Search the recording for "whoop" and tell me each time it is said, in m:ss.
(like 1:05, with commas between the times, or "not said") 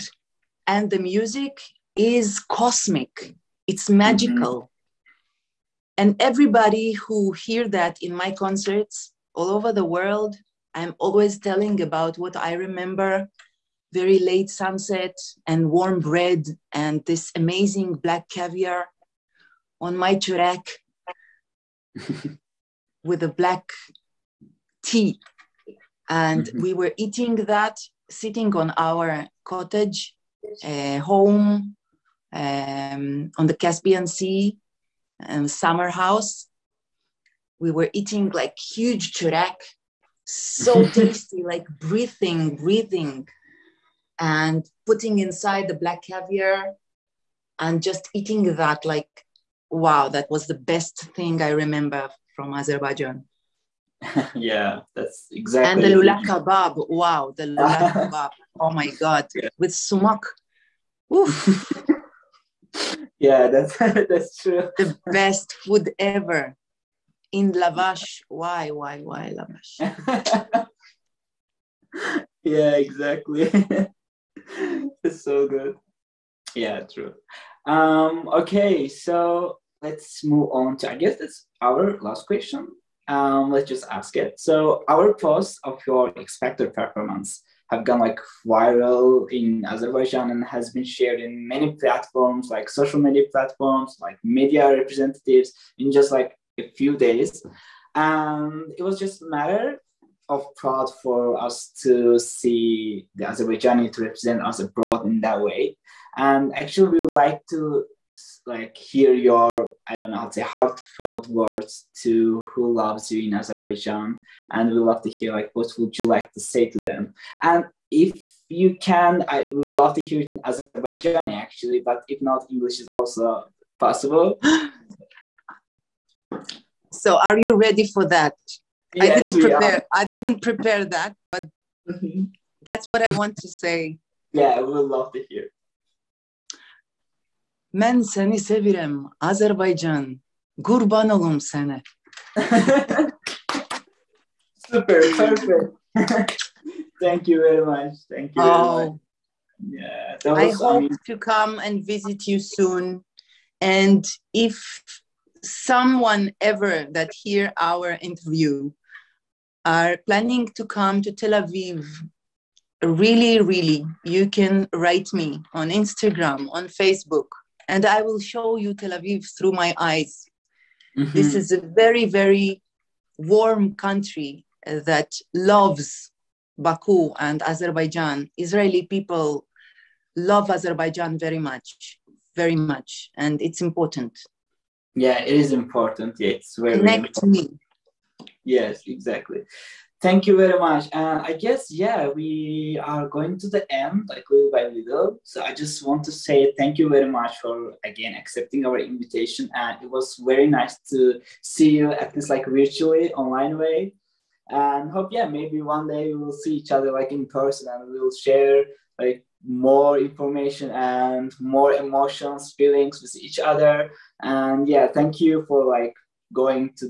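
not said.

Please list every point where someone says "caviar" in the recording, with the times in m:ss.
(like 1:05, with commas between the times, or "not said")
0:18, 0:46.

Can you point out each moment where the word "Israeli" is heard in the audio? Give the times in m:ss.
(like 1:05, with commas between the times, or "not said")
2:58.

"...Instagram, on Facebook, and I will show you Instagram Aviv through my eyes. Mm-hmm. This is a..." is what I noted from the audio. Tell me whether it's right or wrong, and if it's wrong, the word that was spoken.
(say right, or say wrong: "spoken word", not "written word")
wrong: "Tel", not "Instagram".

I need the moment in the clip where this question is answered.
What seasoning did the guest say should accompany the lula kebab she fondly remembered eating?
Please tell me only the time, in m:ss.
0:59.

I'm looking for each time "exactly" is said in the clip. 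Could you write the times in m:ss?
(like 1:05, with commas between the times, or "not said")
0:55, 1:12, 3:08.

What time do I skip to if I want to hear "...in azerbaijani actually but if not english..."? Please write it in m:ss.
2:00.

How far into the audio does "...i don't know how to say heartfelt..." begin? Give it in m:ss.
1:49.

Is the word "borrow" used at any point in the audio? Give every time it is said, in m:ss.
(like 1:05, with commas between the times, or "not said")
not said.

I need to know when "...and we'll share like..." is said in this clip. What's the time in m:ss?
3:27.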